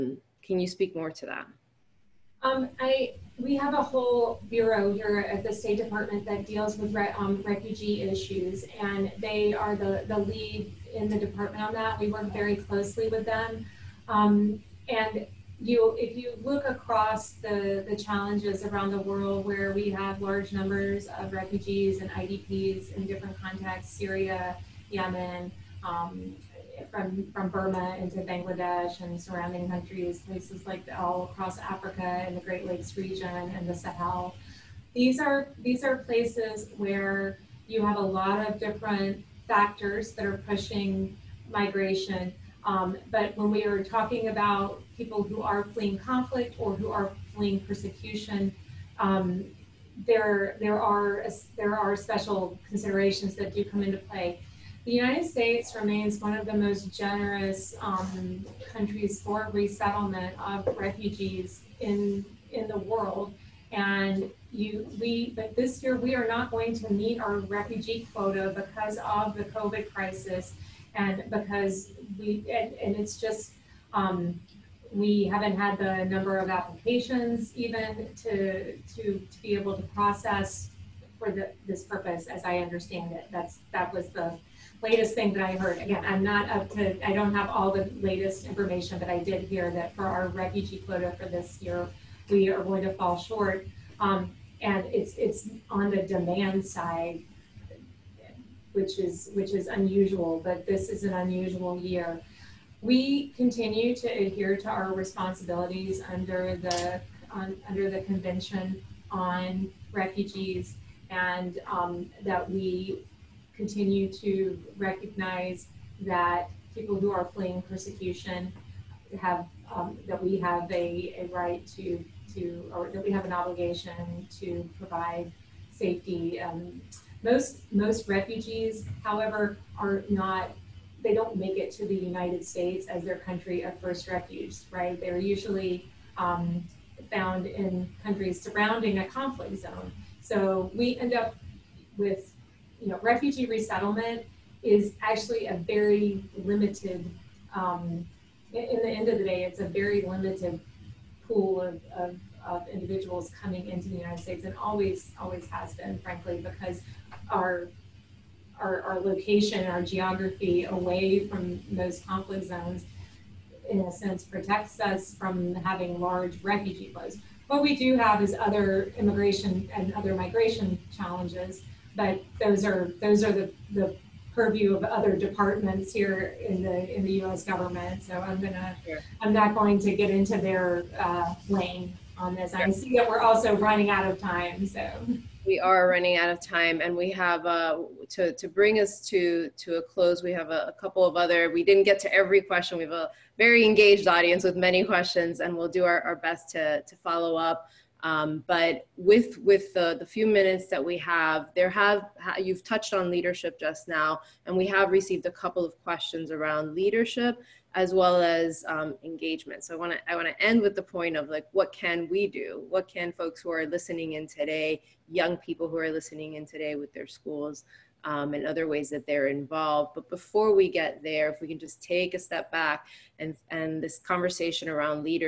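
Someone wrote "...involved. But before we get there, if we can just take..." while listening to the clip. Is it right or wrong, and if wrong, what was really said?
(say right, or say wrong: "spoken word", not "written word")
right.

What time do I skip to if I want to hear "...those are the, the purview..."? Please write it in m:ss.
2:53.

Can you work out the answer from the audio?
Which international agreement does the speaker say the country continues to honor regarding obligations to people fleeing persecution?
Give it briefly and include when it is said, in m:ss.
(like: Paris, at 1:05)
Convention on Refugees, at 1:48.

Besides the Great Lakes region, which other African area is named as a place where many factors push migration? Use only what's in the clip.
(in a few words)
the Sahel.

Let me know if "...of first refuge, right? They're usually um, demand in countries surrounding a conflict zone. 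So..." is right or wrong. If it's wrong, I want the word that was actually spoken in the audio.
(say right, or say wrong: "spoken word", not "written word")
wrong: "found", not "demand".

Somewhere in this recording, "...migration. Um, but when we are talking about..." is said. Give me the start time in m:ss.
0:41.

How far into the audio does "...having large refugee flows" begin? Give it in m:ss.
2:45.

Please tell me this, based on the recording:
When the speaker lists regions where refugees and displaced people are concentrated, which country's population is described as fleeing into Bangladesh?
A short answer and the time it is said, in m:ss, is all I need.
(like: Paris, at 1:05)
Burma, at 0:27.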